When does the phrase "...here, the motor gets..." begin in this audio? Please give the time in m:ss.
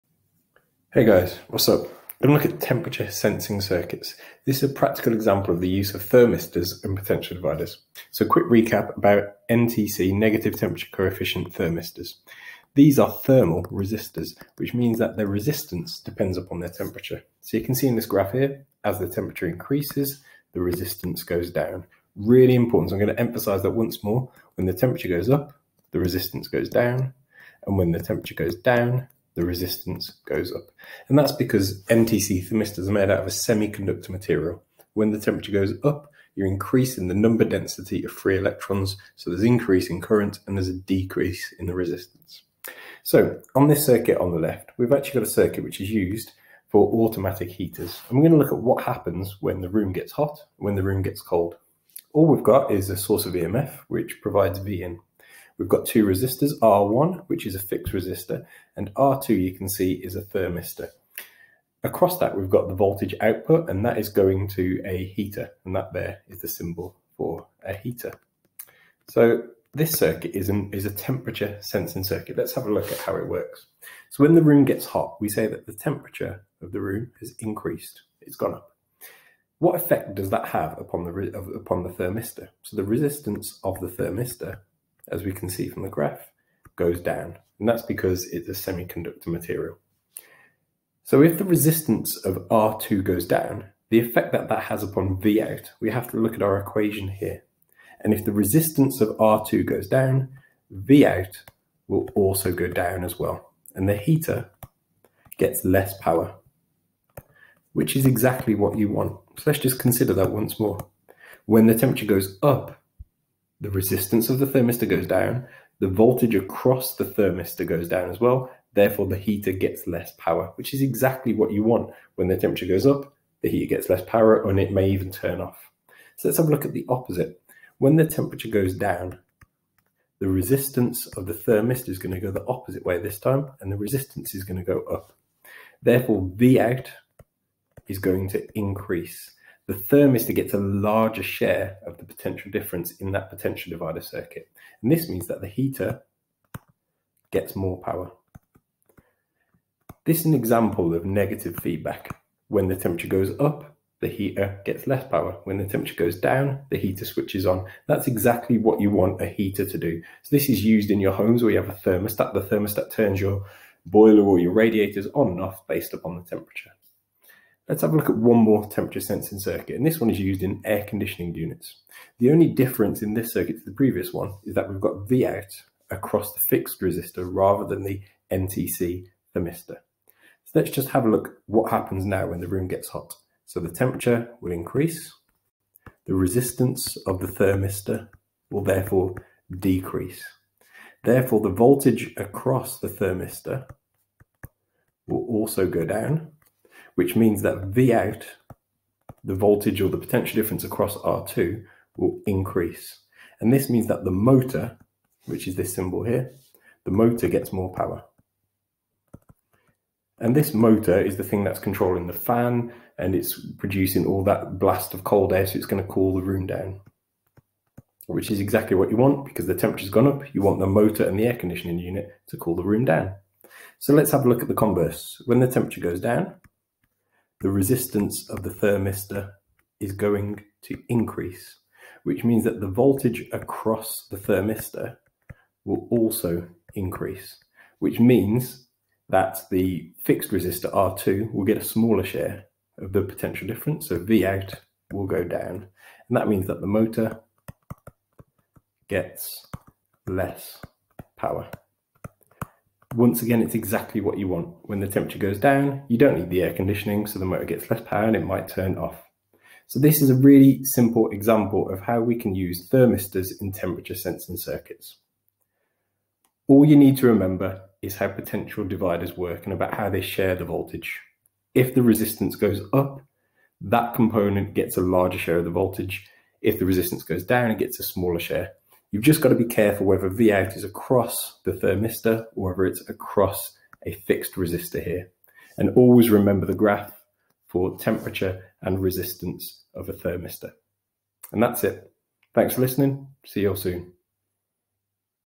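3:26.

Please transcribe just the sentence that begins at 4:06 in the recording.
And that means that the motor gets less power.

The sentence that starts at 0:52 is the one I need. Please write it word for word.
All we've got is a source of EMF, which provides V in.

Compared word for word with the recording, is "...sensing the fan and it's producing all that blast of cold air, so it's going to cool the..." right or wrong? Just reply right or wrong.
wrong.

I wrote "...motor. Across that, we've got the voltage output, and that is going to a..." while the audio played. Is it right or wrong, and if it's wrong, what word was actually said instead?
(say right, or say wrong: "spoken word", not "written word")
wrong: "thermistor", not "motor".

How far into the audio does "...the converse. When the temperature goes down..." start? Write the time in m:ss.
3:44.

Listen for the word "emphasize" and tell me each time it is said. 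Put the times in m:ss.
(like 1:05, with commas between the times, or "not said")
0:23.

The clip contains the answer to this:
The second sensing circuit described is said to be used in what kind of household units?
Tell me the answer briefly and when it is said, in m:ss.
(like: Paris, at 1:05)
air conditioning units, at 2:50.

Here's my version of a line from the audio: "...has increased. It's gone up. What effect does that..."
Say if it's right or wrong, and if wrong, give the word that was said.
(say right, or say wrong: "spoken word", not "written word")
right.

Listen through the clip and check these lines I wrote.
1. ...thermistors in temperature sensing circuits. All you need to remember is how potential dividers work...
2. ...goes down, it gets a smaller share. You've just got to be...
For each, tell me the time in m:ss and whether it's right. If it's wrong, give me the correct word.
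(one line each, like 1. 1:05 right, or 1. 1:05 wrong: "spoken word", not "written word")
1. 4:22 right
2. 4:37 right.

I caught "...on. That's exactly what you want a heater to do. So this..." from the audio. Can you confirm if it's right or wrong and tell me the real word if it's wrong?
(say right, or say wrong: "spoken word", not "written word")
right.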